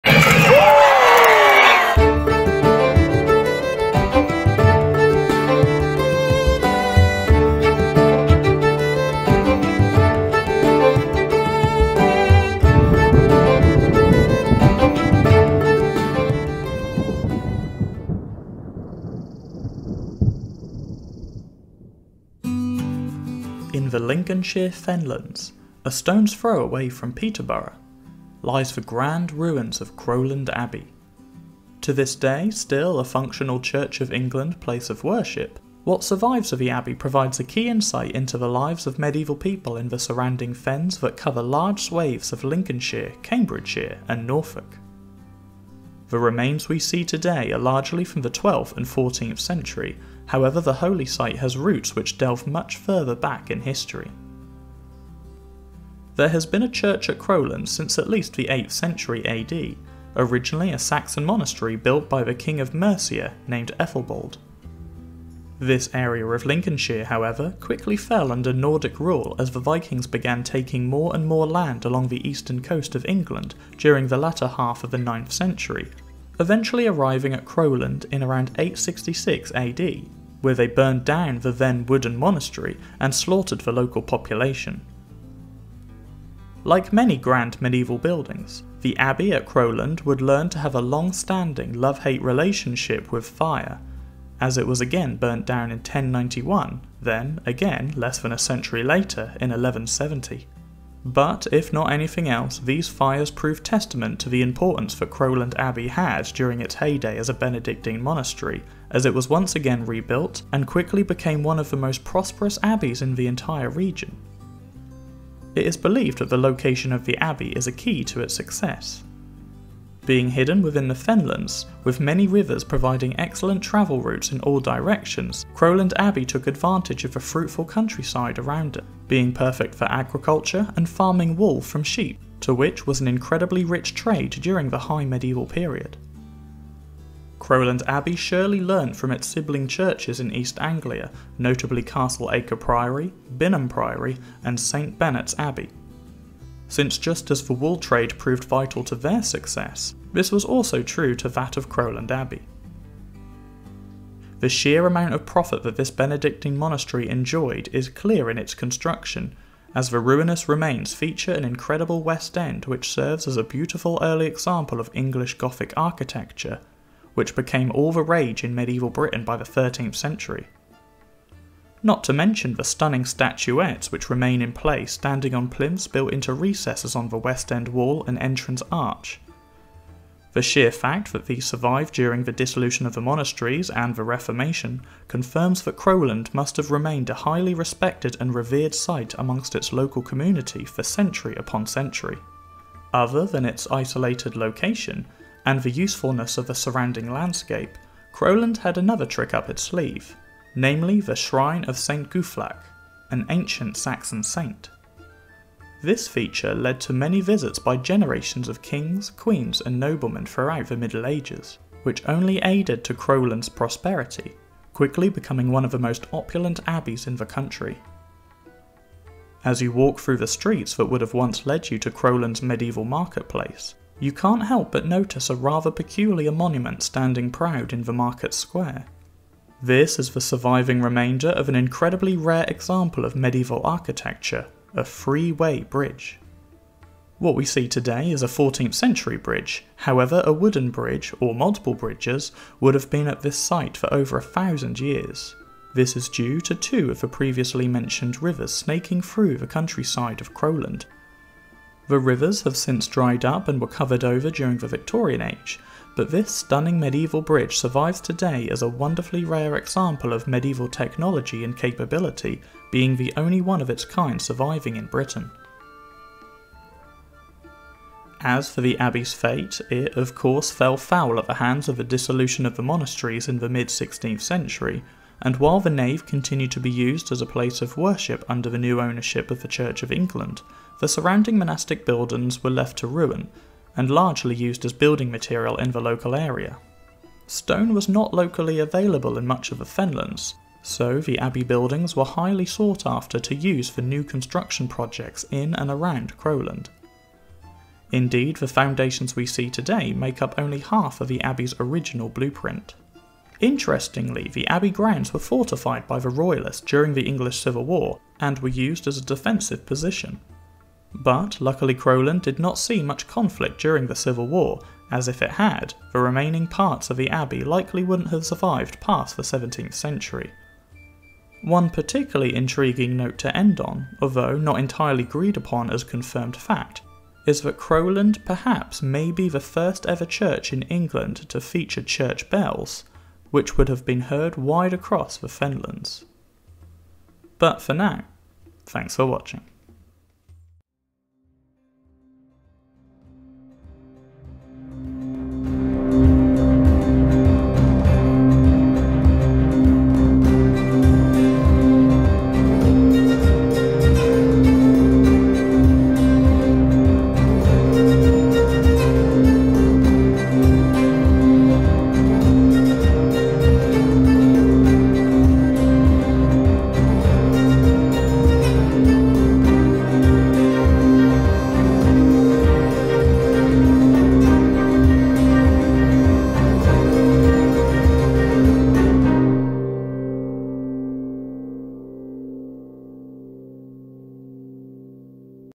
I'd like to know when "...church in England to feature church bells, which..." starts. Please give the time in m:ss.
5:30.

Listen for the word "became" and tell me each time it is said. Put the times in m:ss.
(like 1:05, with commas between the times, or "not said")
1:51, 2:47.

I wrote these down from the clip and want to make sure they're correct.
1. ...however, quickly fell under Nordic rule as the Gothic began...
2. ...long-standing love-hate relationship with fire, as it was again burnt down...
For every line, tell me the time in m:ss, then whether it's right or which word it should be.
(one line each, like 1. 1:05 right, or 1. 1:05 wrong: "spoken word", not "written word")
1. 1:07 wrong: "Vikings", not "Gothic"
2. 1:30 right.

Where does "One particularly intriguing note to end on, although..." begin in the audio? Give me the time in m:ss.
5:21.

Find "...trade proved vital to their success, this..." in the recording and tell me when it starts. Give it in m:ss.
2:27.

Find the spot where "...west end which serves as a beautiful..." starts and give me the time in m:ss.
2:42.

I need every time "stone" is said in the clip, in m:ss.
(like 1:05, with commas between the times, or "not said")
0:25, 4:47.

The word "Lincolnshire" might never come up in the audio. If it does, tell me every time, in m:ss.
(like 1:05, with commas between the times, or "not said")
0:23, 0:42, 1:06.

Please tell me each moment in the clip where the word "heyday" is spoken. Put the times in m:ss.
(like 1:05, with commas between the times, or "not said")
1:46.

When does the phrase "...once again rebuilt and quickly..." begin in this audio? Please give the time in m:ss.
1:49.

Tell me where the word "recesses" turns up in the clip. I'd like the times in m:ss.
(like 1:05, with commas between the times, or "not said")
2:56.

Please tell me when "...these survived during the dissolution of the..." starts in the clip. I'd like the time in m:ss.
3:01.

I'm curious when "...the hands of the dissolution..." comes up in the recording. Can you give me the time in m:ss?
4:31.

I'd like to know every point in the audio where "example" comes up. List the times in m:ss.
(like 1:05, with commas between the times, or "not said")
2:44, 3:52, 4:19.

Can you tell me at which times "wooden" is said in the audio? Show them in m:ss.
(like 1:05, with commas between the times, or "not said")
1:21, 4:00.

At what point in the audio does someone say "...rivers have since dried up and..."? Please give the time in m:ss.
4:11.